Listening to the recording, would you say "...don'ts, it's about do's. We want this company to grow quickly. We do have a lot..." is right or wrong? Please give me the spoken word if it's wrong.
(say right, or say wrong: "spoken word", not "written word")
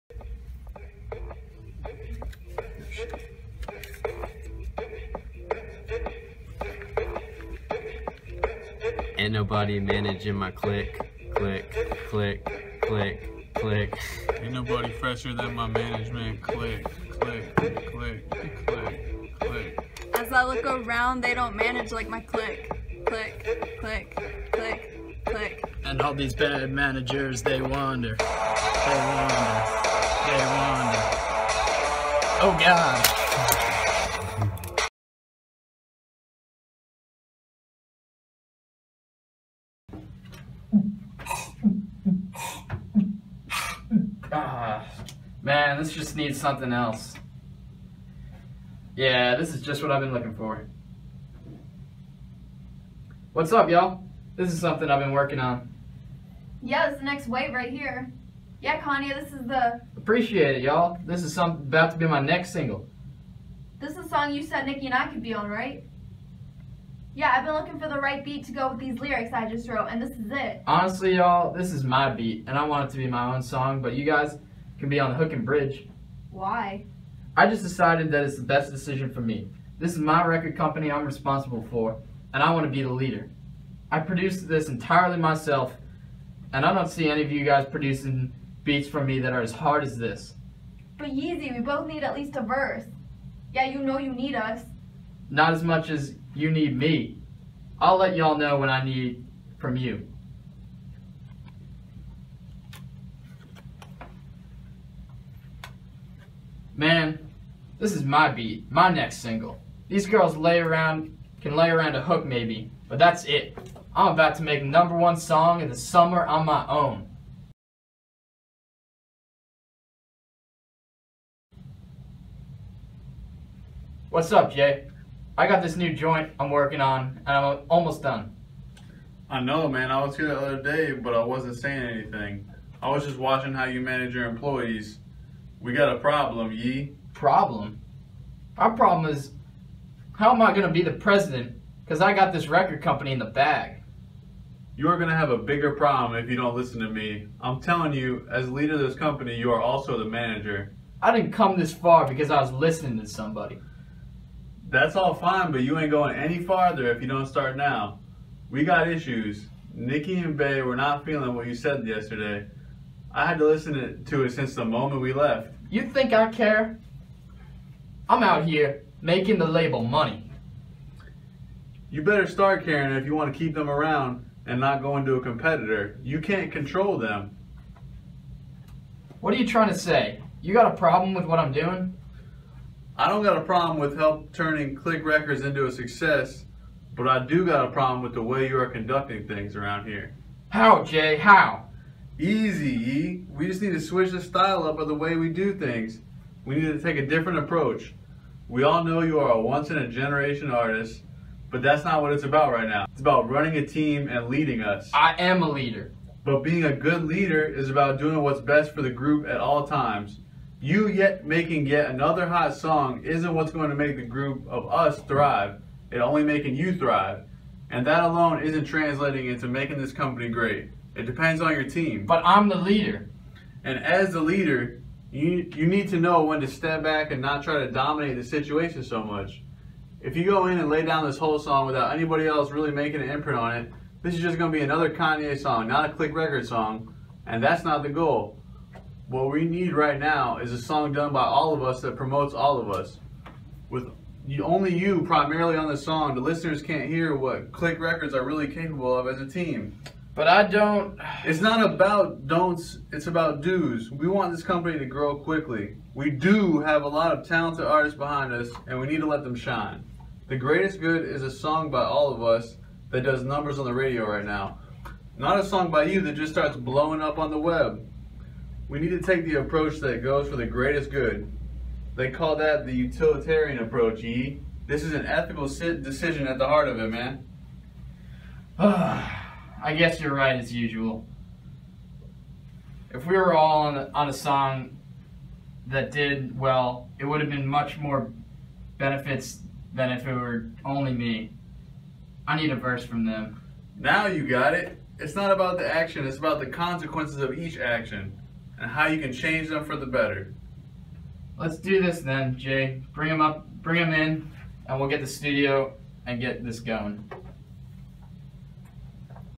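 right.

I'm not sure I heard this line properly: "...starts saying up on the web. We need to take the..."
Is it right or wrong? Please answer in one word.
wrong.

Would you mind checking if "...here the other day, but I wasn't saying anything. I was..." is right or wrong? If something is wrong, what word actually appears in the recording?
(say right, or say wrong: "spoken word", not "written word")
right.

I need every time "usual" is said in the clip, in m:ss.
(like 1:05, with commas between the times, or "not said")
4:40.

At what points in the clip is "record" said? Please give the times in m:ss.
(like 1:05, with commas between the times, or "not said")
1:20, 2:22, 3:05, 3:56, 4:07.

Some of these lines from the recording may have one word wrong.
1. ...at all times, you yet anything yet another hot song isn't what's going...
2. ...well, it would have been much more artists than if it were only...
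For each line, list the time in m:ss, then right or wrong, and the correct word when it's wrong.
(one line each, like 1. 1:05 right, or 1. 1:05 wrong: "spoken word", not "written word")
1. 3:29 wrong: "making", not "anything"
2. 4:46 wrong: "benefits", not "artists".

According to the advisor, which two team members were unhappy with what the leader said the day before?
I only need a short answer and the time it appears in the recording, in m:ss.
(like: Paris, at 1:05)
Nicki and Bey, at 2:39.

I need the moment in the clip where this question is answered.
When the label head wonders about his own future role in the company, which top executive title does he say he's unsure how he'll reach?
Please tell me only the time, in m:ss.
2:20.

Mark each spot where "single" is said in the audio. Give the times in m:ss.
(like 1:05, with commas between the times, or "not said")
1:02, 1:49.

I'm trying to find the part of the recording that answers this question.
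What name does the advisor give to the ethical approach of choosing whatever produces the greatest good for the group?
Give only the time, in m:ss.
4:32.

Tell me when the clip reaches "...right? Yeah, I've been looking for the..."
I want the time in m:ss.
1:05.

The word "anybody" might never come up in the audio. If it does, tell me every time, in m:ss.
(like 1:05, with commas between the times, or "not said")
3:51.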